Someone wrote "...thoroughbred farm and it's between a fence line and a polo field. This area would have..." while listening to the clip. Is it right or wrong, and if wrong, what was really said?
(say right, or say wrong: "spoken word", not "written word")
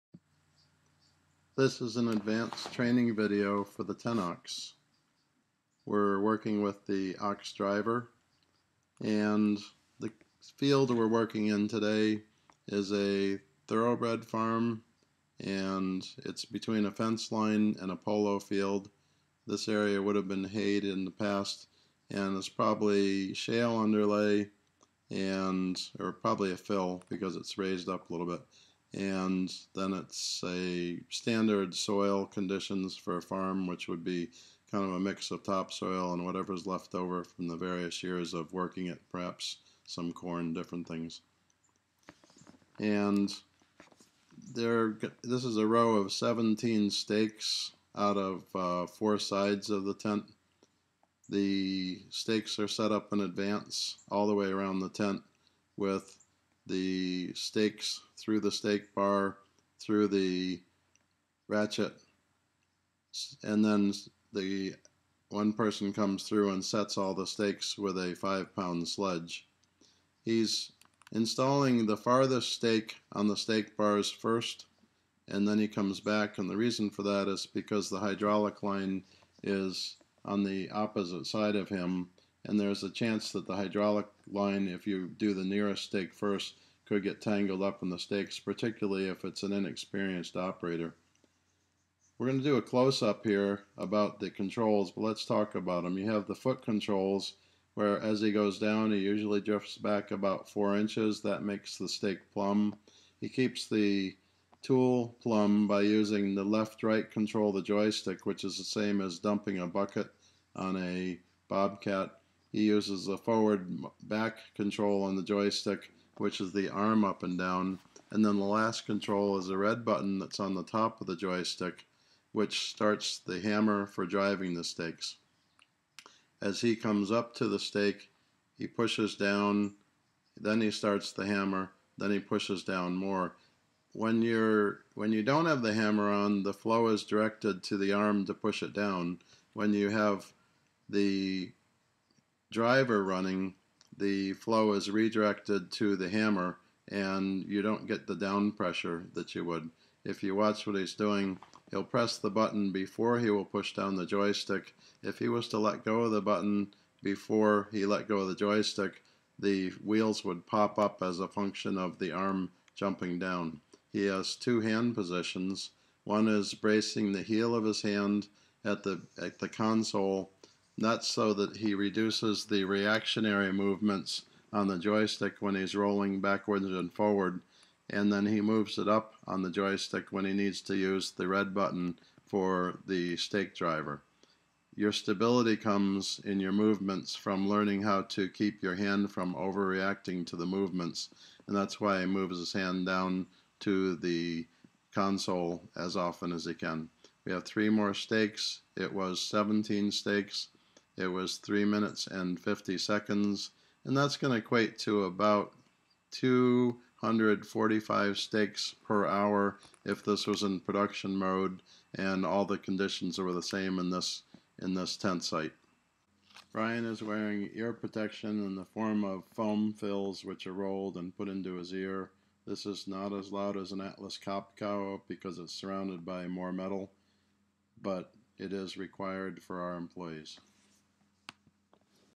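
right.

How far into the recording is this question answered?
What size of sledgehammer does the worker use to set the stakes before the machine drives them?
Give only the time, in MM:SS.
01:08.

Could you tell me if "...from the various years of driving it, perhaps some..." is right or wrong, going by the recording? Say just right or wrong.
wrong.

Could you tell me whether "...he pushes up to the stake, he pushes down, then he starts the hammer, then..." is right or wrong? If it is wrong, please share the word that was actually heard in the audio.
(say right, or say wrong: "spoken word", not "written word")
wrong: "comes", not "pushes".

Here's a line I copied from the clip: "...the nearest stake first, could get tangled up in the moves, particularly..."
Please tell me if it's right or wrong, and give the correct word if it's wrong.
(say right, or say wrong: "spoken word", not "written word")
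wrong: "stakes", not "moves".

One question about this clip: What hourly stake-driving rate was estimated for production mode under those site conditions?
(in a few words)
245 stakes per hour.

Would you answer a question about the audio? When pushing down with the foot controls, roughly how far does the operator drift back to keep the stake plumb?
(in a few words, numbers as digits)
4 inches.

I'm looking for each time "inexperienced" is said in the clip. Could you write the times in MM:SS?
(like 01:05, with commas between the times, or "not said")
01:29.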